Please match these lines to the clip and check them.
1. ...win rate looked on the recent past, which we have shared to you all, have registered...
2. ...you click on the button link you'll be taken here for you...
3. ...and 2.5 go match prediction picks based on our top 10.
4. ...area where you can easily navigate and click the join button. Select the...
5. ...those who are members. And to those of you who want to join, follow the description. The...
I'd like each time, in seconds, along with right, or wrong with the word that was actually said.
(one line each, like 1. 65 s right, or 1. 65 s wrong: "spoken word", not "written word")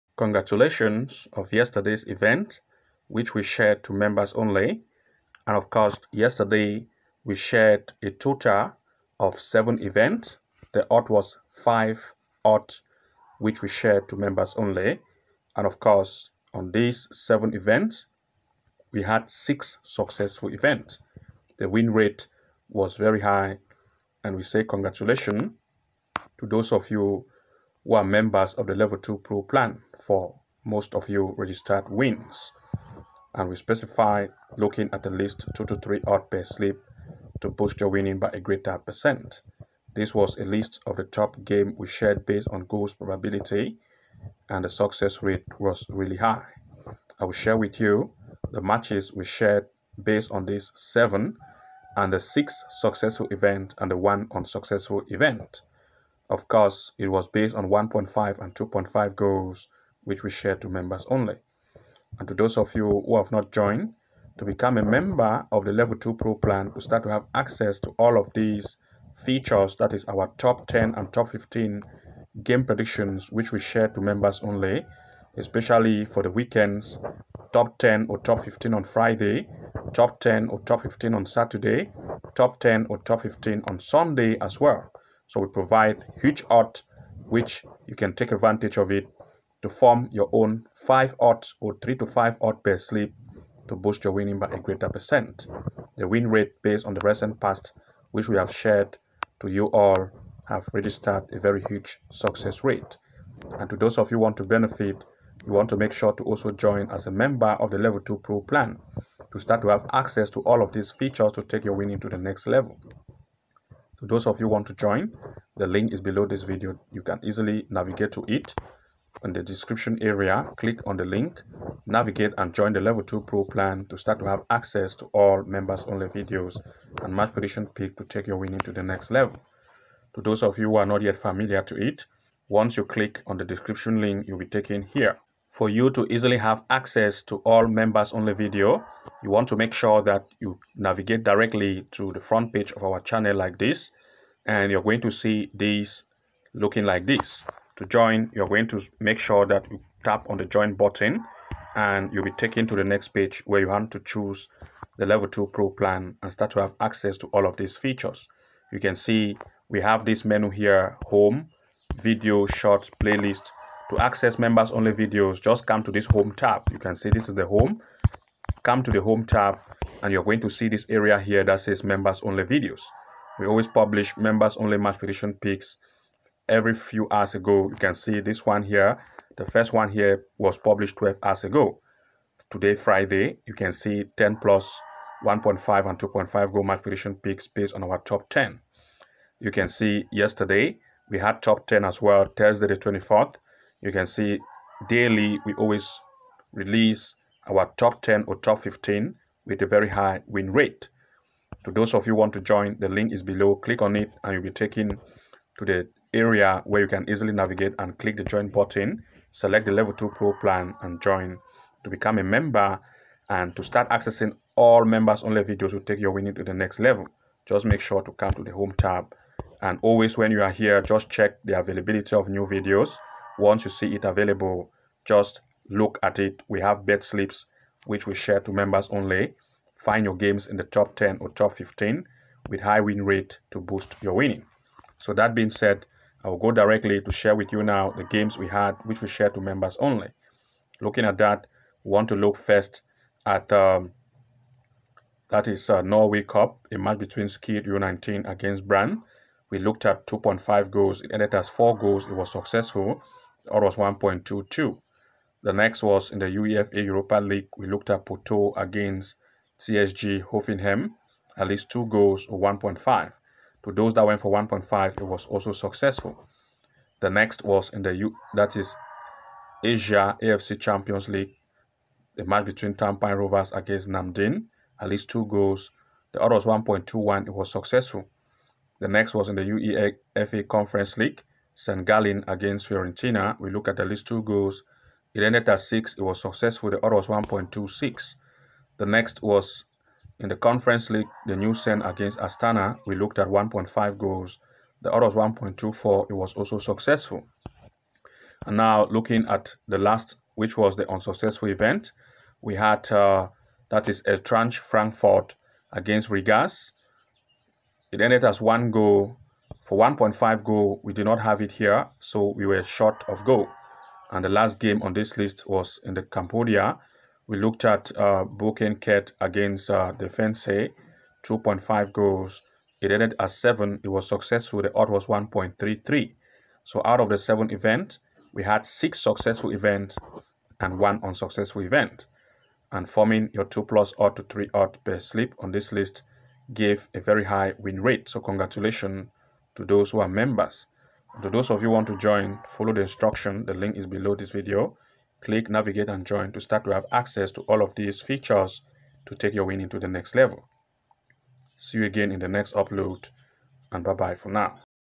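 1. 96 s wrong: "based", not "looked"
2. 132 s wrong: "description", not "button"
3. 185 s right
4. 206 s right
5. 339 s wrong: "instruction", not "description".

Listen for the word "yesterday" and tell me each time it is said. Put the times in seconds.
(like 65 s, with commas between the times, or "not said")
1 s, 6 s, 190 s.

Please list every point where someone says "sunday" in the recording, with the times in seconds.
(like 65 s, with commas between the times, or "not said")
83 s.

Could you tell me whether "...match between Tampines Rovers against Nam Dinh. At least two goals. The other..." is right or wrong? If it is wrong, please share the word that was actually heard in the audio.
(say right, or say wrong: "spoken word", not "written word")
right.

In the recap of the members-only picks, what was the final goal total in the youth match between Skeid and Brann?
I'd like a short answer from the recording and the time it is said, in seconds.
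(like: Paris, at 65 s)
4 goals, at 251 s.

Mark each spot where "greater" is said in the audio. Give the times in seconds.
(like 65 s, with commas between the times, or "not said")
38 s, 94 s.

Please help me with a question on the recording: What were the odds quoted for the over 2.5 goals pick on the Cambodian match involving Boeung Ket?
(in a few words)
1.33.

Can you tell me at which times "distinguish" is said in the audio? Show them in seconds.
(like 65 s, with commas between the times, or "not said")
not said.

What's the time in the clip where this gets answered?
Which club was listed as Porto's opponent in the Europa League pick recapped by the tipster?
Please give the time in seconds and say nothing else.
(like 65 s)
259 s.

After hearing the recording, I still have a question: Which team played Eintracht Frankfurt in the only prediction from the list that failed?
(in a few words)
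Rigas.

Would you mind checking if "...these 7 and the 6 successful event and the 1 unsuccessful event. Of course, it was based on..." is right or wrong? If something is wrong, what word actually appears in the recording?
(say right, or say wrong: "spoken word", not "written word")
right.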